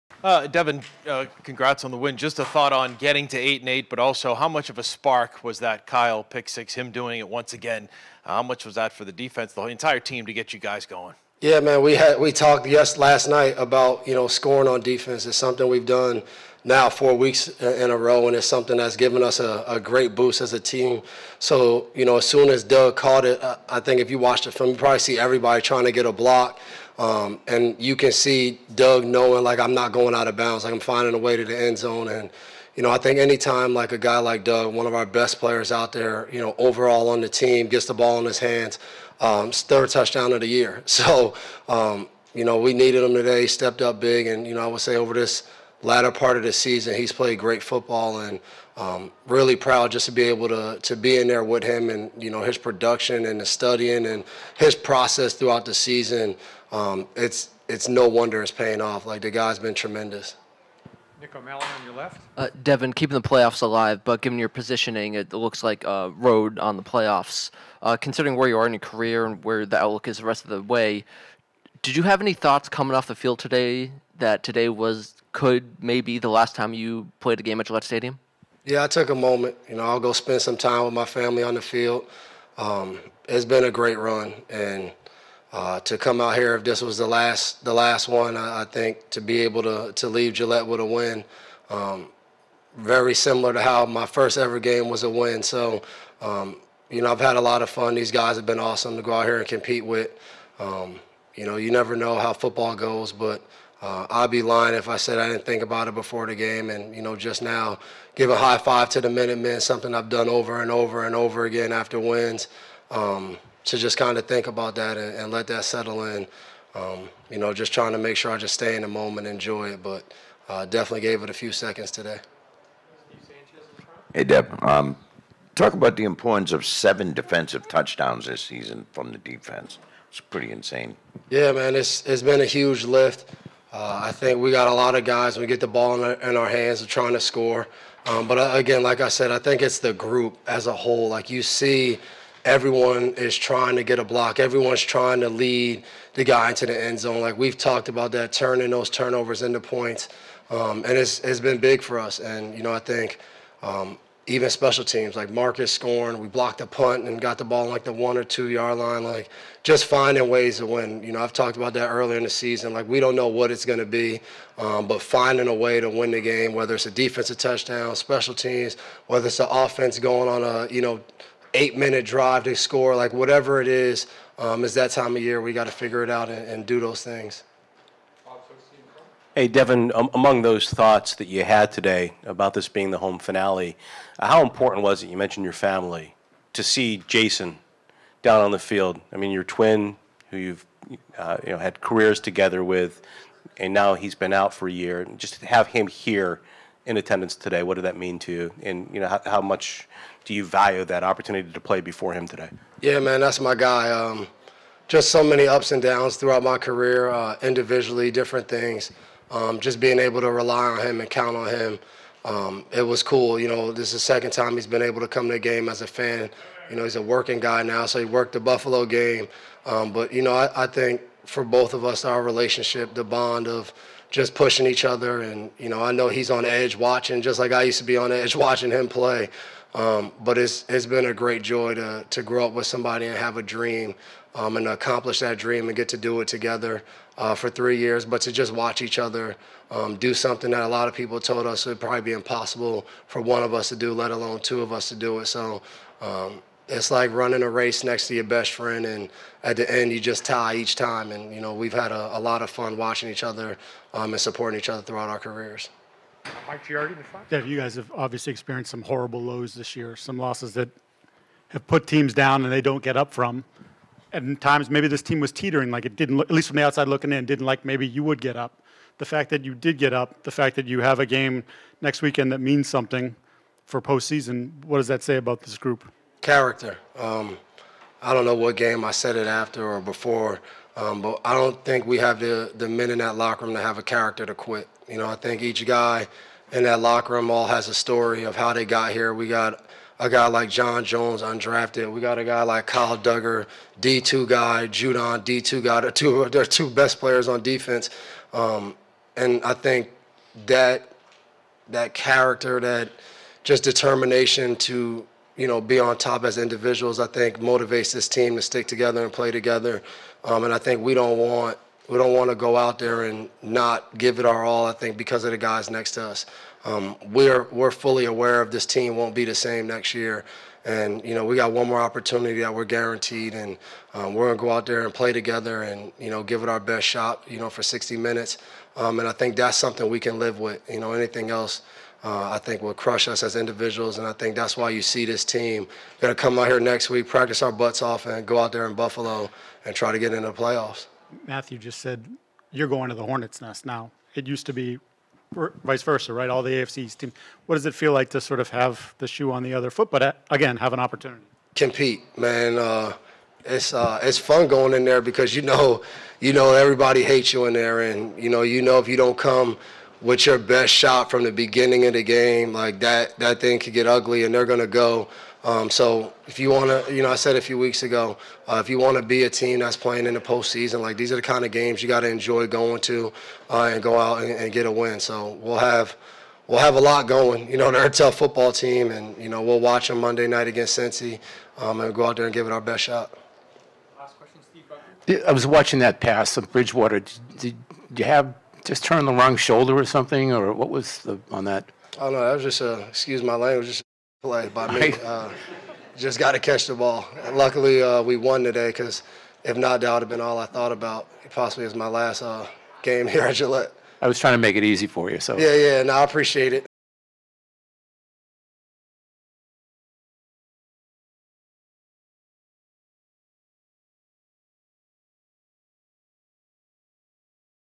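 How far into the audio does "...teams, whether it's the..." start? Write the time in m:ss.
2:48.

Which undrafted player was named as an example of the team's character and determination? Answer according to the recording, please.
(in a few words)
John Jones.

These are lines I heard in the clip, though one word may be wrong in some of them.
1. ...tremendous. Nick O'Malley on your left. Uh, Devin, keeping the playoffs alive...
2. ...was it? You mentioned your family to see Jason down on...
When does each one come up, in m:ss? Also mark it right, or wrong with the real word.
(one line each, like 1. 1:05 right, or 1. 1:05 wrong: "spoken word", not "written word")
1. 0:59 right
2. 3:04 right.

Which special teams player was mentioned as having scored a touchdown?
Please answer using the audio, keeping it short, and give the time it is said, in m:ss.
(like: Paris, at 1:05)
Marcus, at 2:35.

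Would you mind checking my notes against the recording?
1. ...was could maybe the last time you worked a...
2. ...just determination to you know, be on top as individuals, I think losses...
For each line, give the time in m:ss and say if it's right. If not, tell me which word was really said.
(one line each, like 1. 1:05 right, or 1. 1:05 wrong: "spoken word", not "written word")
1. 1:14 wrong: "played", not "worked"
2. 5:03 wrong: "motivates", not "losses".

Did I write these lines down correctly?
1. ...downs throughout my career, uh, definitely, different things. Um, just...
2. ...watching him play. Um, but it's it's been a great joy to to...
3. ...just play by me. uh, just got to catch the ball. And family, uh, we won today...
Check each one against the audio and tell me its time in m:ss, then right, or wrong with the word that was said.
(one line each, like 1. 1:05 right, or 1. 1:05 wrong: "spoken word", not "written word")
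1. 3:25 wrong: "individually", not "definitely"
2. 3:48 right
3. 6:33 wrong: "luckily", not "family".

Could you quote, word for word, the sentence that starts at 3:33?
You know, this is the second time he's been able to come to the game as a fan.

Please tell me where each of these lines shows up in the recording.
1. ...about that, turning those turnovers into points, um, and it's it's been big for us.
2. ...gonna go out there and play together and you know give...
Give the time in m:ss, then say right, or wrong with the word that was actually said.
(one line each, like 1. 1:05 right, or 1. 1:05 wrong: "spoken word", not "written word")
1. 2:27 right
2. 5:24 right.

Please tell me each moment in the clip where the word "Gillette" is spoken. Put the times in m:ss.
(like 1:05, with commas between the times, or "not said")
1:17, 1:30, 6:43.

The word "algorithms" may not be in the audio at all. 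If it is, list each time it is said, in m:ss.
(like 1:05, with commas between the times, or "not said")
not said.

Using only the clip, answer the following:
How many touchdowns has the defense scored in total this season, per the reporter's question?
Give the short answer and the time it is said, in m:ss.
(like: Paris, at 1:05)
7, at 2:06.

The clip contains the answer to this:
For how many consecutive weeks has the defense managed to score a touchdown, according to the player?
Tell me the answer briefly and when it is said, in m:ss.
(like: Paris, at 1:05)
4, at 0:16.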